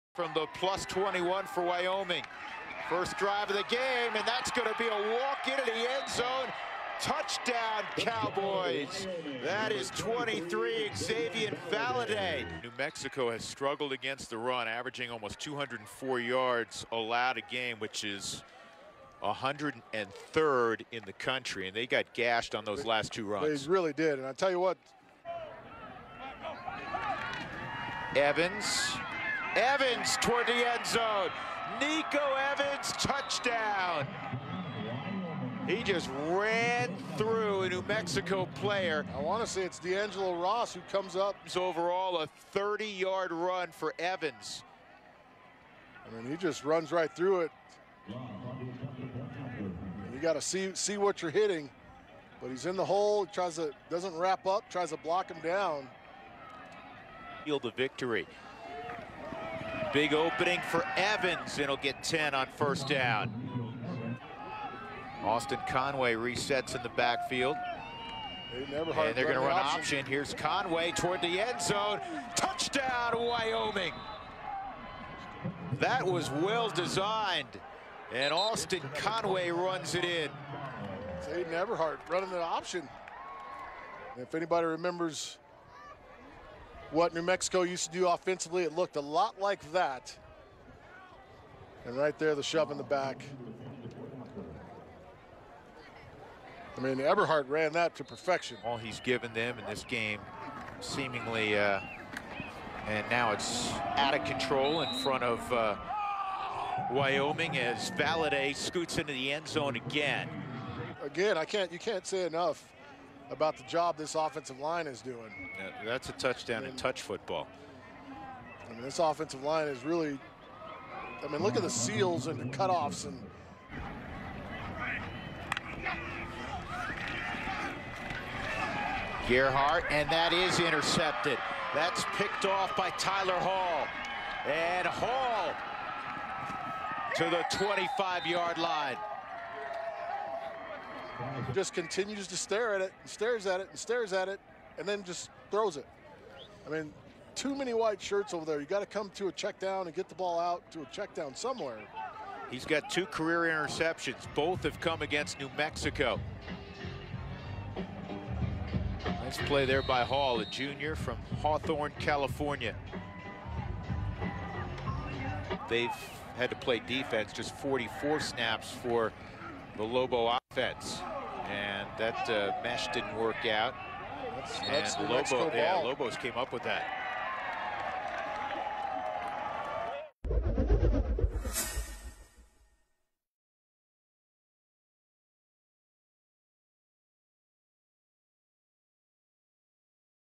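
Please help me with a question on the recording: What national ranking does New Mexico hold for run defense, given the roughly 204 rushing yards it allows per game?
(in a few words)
103rd.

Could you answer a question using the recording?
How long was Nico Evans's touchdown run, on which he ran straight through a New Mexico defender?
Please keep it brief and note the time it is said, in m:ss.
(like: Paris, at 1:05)
30 yards, at 0:42.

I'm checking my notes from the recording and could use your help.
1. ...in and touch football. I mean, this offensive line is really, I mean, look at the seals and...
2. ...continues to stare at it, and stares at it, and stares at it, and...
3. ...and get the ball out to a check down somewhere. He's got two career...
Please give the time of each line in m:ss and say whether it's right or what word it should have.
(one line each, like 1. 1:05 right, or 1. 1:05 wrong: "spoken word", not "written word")
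1. 1:56 right
2. 2:21 right
3. 2:29 right.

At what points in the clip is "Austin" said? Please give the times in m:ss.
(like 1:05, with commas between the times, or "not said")
1:05, 1:18.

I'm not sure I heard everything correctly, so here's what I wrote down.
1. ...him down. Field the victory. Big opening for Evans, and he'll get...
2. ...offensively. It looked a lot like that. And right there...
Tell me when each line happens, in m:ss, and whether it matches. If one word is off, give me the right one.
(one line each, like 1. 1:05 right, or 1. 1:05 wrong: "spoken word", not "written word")
1. 0:55 right
2. 1:28 right.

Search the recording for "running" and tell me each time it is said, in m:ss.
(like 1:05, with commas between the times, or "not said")
1:22.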